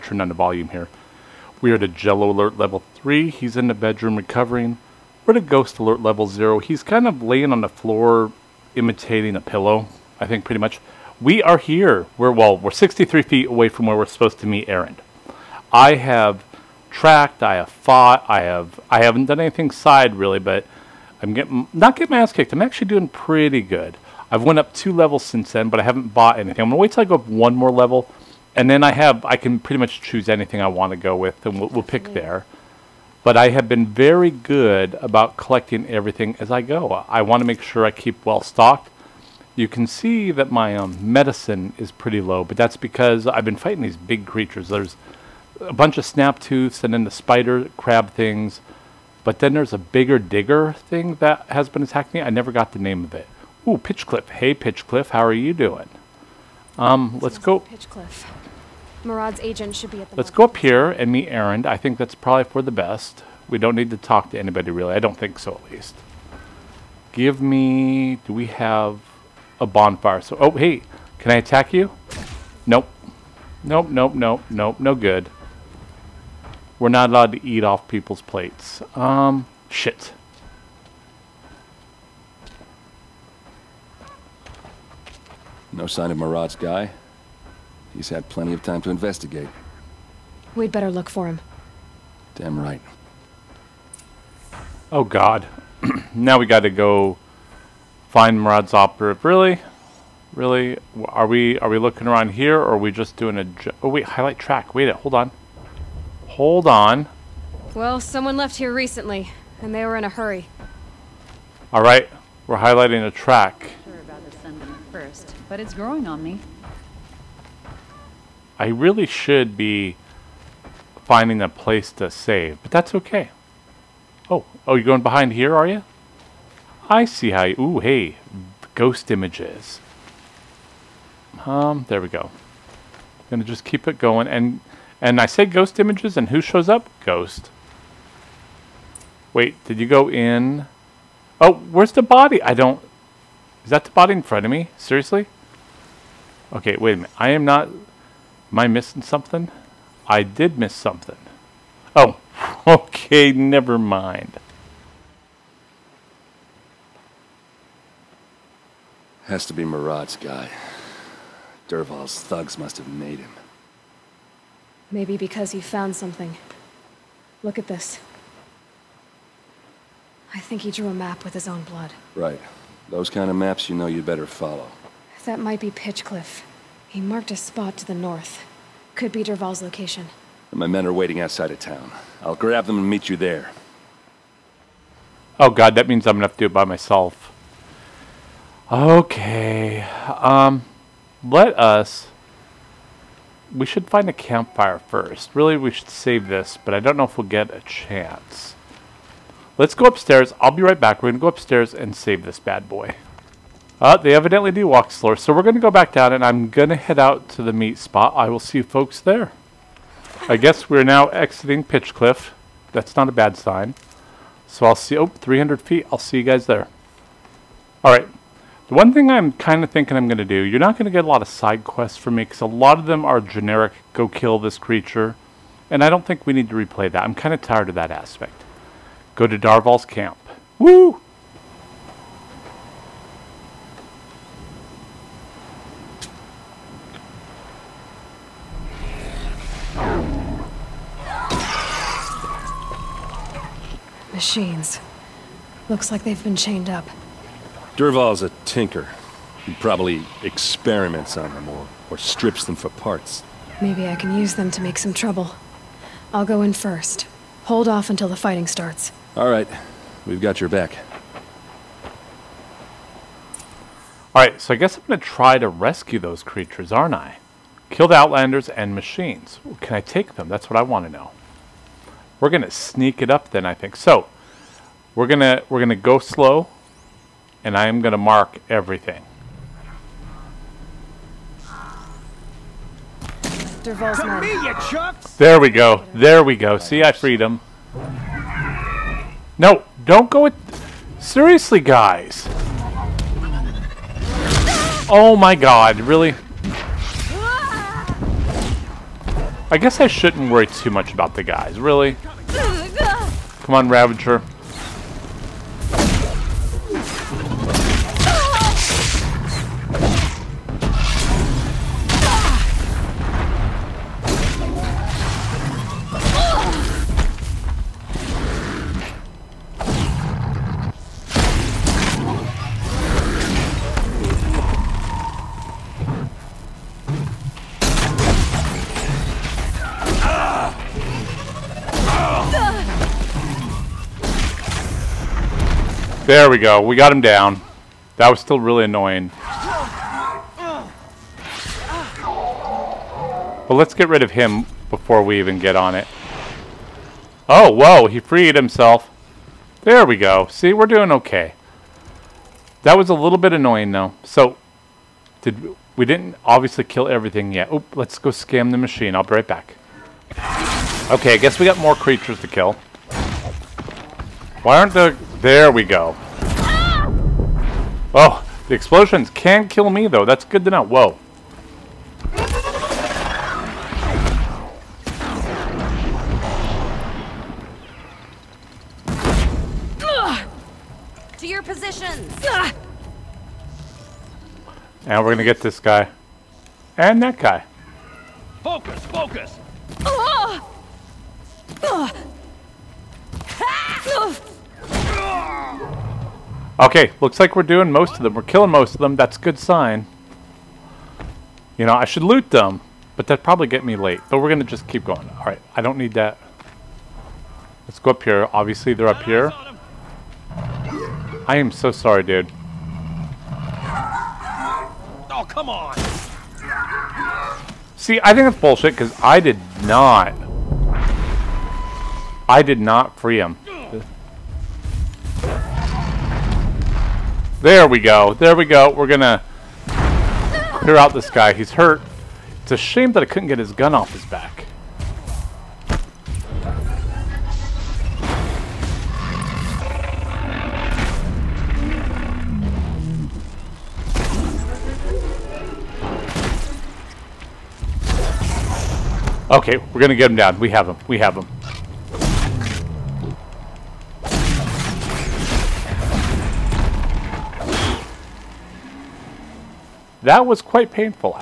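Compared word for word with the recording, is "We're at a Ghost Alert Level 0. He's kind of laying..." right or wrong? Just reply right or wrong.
right.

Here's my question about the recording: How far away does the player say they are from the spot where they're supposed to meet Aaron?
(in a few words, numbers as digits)
63 feet.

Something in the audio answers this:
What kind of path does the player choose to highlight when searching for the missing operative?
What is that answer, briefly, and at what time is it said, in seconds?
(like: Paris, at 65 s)
a track, at 104 s.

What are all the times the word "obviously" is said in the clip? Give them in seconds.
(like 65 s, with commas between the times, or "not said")
356 s, 408 s.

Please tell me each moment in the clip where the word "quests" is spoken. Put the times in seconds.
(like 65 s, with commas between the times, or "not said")
221 s.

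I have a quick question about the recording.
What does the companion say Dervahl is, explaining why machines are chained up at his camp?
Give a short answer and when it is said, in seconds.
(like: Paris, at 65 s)
a tinker, at 248 s.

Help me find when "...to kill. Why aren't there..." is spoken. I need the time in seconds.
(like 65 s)
362 s.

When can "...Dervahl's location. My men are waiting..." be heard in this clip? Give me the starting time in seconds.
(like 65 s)
179 s.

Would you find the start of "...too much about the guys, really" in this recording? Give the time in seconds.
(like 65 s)
300 s.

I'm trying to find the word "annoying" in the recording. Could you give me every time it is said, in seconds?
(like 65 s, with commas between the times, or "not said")
338 s, 353 s.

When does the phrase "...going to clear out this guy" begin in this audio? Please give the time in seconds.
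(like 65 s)
428 s.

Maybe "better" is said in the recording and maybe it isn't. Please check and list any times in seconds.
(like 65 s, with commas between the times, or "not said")
90 s, 174 s.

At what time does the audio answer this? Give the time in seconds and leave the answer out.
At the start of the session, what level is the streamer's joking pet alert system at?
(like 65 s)
1 s.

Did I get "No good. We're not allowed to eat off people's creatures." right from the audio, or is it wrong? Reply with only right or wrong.
wrong.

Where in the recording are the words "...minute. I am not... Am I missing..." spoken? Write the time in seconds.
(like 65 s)
146 s.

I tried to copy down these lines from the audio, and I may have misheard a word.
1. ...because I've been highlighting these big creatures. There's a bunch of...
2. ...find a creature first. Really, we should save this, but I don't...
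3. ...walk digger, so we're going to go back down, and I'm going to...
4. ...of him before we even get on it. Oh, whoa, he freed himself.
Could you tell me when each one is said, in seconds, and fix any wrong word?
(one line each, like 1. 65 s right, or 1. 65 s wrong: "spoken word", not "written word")
1. 42 s wrong: "fighting", not "highlighting"
2. 193 s wrong: "campfire", not "creature"
3. 204 s wrong: "slower", not "digger"
4. 344 s right.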